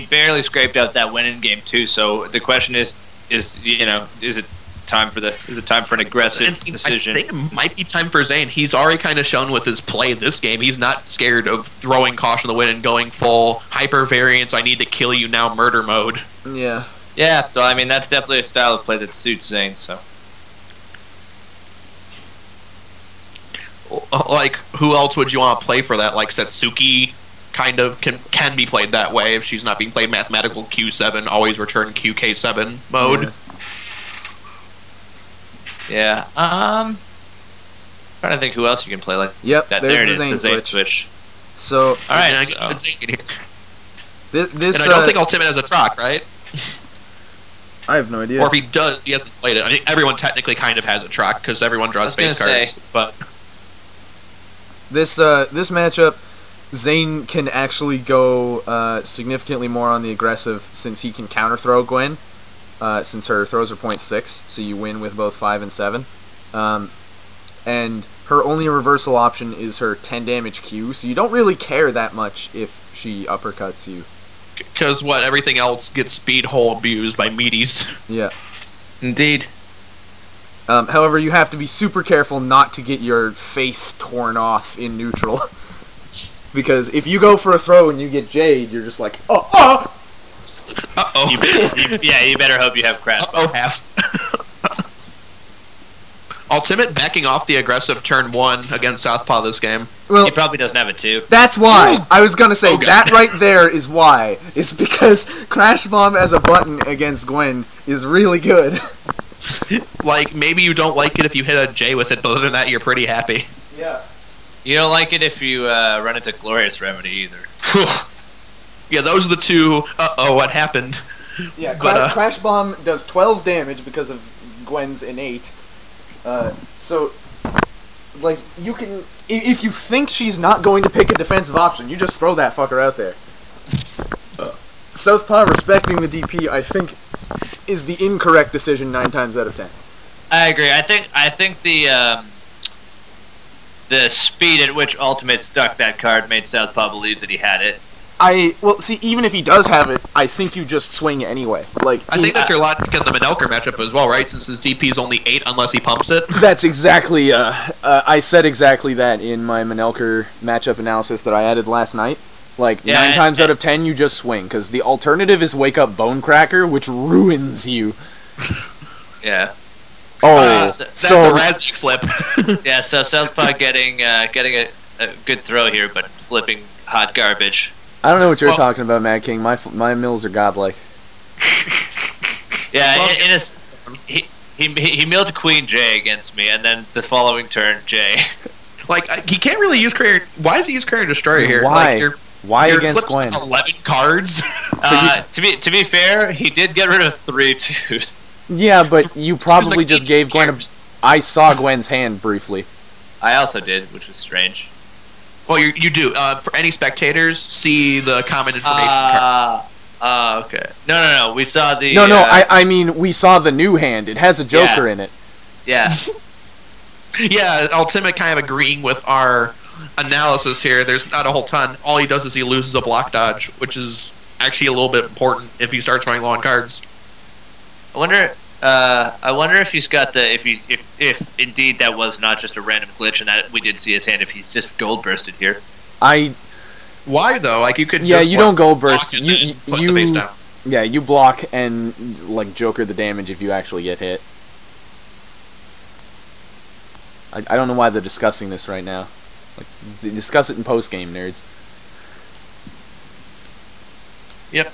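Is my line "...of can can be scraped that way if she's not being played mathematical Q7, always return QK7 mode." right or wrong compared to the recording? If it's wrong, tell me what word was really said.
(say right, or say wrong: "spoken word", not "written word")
wrong: "played", not "scraped".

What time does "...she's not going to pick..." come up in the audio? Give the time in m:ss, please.
2:10.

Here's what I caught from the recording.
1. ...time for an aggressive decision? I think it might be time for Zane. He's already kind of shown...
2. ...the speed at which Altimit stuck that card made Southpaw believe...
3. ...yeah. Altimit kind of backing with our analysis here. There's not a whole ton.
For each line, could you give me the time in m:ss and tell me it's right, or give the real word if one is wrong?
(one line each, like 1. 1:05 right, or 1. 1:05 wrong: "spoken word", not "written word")
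1. 0:05 right
2. 2:23 right
3. 3:37 wrong: "agreeing", not "backing".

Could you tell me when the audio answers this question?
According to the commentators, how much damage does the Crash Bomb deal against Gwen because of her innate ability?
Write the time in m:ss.
2:03.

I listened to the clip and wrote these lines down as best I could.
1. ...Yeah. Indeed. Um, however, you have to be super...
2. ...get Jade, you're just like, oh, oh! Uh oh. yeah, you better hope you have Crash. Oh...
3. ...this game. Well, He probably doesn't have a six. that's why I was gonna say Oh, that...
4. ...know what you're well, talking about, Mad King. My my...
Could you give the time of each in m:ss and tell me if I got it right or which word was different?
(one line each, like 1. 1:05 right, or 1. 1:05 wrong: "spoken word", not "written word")
1. 1:18 right
2. 1:28 right
3. 1:39 wrong: "two", not "six"
4. 2:58 right.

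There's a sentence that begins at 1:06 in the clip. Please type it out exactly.
Um, and her only reversal option is her 10 damage Q, so you don't really care that much if she uppercuts you.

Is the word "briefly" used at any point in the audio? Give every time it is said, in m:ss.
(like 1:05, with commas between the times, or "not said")
3:22.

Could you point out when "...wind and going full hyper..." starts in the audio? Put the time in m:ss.
0:12.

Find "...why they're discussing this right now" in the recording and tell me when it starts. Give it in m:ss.
4:07.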